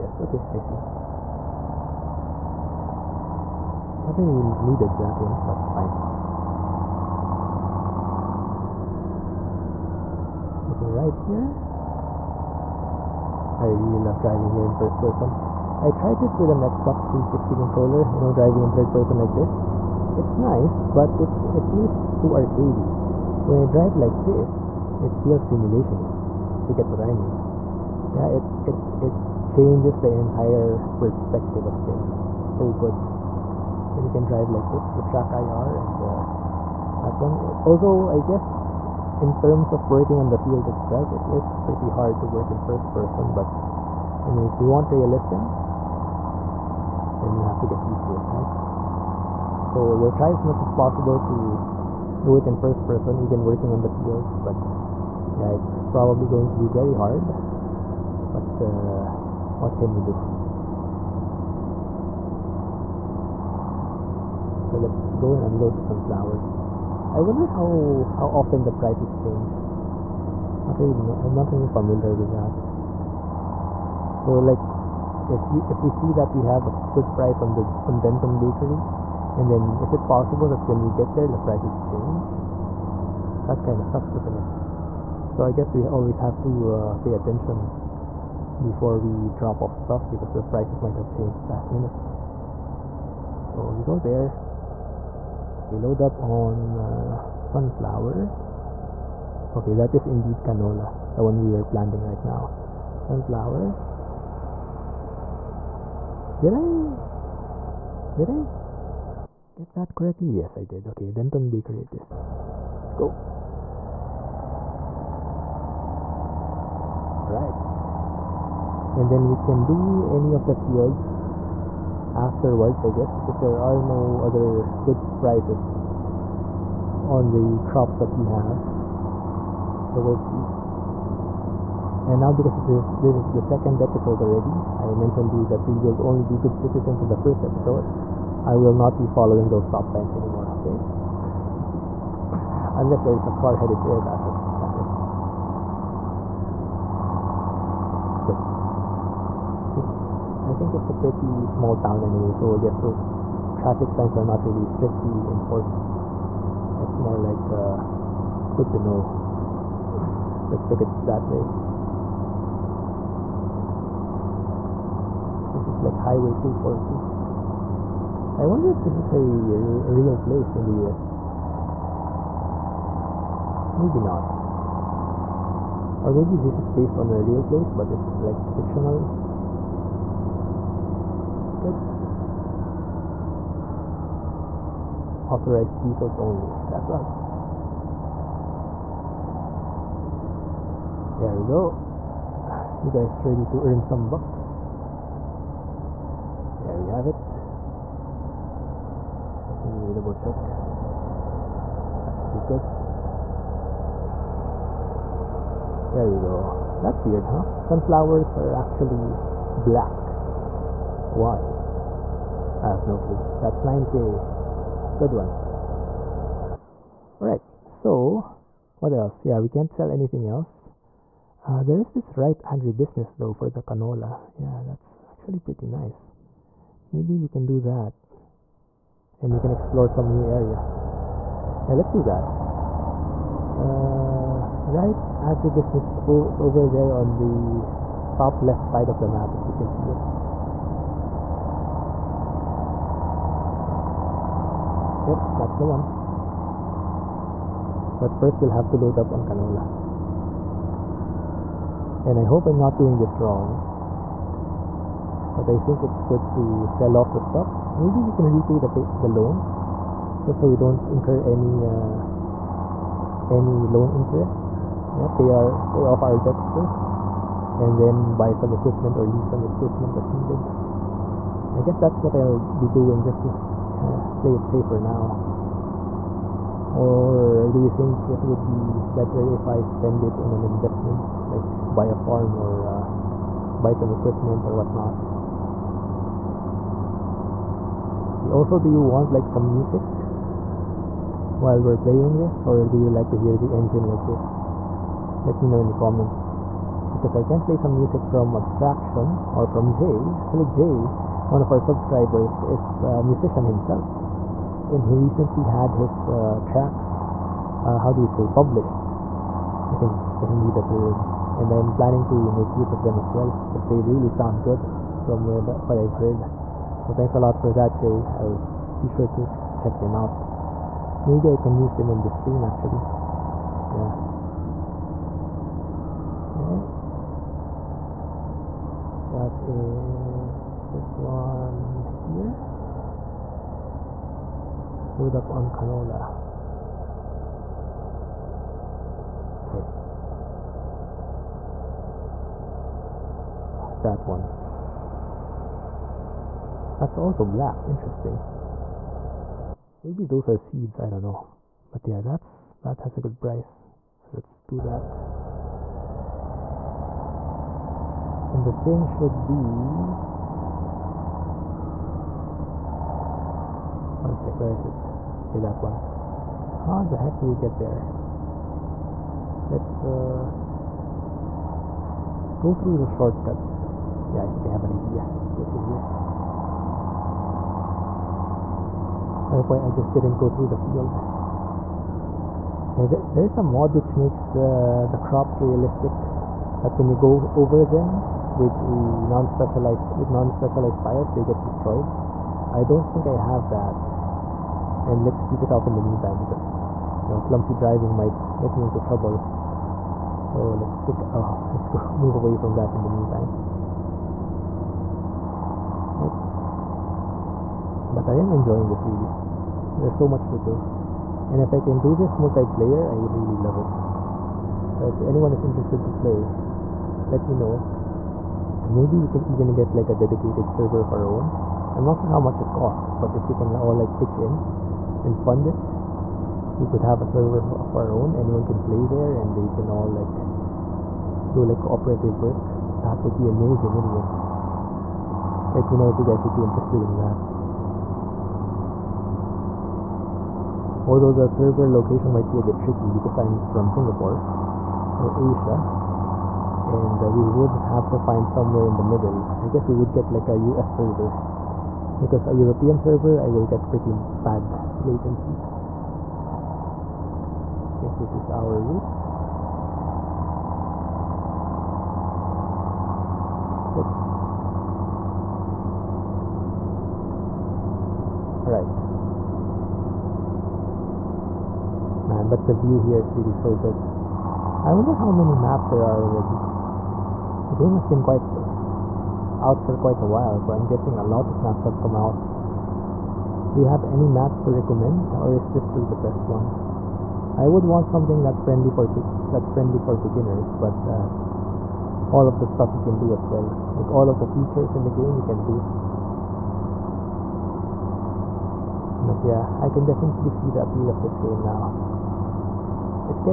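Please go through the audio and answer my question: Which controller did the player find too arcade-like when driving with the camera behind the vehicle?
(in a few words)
Xbox 360 controller.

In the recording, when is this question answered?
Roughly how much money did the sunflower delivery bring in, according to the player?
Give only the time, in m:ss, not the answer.
3:33.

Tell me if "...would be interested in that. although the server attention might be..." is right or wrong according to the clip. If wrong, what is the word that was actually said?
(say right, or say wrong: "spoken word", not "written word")
wrong: "location", not "attention".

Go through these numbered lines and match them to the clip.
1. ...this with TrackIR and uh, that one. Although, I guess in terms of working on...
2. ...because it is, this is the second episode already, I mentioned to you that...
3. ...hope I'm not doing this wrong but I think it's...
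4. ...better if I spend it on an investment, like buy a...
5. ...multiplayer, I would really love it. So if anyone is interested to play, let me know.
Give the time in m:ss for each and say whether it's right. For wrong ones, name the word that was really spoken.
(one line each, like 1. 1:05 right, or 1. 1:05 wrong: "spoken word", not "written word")
1. 0:34 right
2. 2:12 right
3. 4:12 right
4. 4:38 right
5. 6:52 right.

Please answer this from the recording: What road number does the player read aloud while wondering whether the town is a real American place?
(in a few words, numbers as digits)
Highway 242.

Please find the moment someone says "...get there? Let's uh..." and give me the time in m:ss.
6:07.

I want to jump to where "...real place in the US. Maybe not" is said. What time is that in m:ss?
2:49.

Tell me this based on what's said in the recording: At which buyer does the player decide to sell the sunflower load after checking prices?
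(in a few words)
Denton Bakery.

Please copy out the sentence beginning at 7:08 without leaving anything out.
Anyone can play there and we can all like do like cooperative work.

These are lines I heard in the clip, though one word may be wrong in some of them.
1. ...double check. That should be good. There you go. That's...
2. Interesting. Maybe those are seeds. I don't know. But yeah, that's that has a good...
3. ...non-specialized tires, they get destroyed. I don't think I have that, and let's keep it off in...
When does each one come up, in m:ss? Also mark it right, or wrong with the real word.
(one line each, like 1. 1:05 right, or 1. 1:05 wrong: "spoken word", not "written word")
1. 3:19 right
2. 5:47 right
3. 6:30 right.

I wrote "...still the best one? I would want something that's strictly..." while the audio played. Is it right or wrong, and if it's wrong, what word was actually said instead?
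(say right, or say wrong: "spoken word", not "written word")
wrong: "friendly", not "strictly".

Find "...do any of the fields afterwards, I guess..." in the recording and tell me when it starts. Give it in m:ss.
1:59.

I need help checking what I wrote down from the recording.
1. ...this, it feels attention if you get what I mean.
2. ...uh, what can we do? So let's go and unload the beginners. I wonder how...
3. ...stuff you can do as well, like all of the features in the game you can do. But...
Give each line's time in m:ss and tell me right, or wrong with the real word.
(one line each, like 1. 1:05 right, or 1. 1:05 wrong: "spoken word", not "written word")
1. 0:24 wrong: "simulation", not "attention"
2. 0:58 wrong: "sunflowers", not "beginners"
3. 8:12 right.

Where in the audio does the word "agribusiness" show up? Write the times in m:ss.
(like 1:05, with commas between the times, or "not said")
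3:42, 3:55.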